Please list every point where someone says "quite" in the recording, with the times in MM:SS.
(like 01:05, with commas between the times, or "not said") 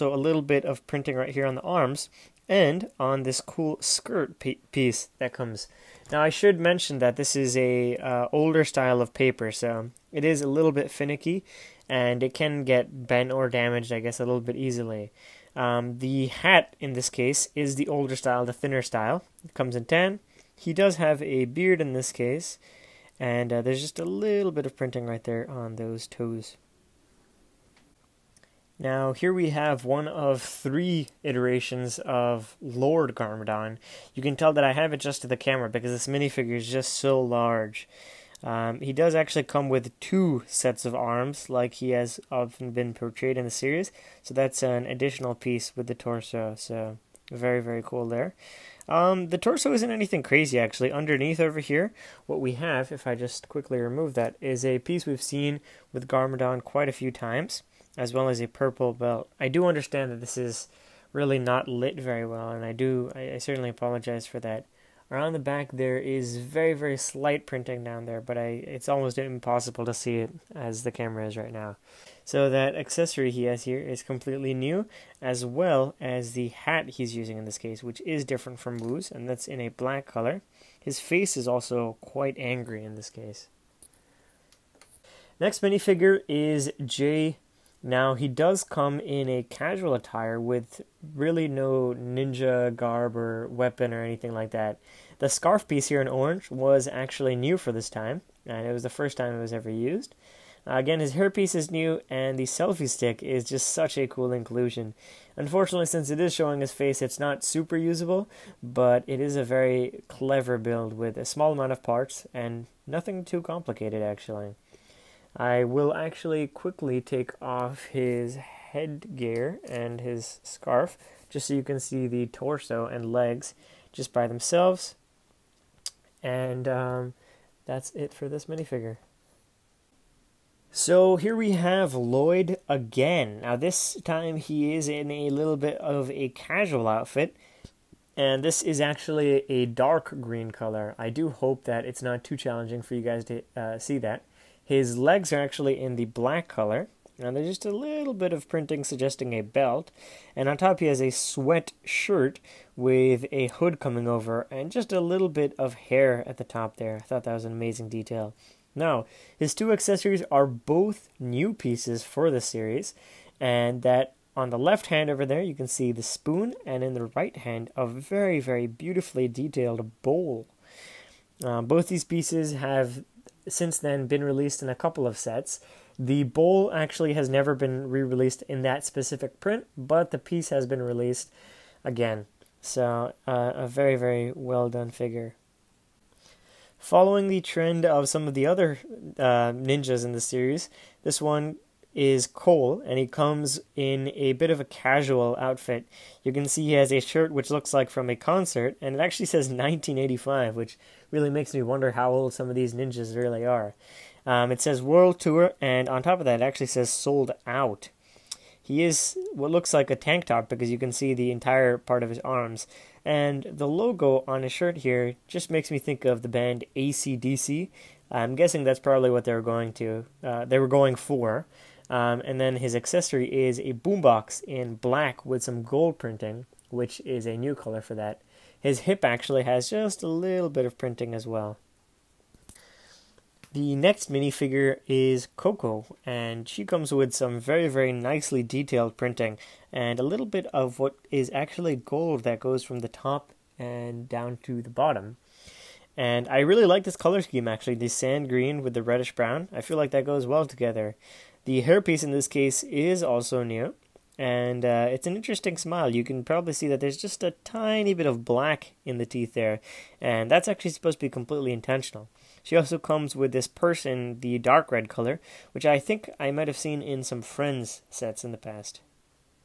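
00:56, 01:22.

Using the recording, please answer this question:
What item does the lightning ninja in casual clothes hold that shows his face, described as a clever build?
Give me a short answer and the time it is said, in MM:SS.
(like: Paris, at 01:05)
selfie stick, at 01:42.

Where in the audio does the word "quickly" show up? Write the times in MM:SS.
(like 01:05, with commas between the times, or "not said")
00:53, 01:56.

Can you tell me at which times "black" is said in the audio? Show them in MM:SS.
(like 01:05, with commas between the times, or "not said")
01:19, 02:26, 03:44, 04:18.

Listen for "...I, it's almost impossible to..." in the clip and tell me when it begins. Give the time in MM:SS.
01:08.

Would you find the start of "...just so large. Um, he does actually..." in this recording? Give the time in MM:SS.
00:36.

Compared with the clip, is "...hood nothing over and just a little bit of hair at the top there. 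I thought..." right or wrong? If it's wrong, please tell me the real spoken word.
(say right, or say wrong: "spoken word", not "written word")
wrong: "coming", not "nothing".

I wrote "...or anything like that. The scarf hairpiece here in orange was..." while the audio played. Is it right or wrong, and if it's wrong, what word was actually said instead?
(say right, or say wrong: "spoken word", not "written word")
wrong: "piece", not "hairpiece".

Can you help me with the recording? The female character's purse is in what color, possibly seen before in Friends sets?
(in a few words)
dark red.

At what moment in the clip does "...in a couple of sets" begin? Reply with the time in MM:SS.
02:54.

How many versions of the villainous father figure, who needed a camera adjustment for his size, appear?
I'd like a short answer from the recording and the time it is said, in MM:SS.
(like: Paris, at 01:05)
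3, at 00:30.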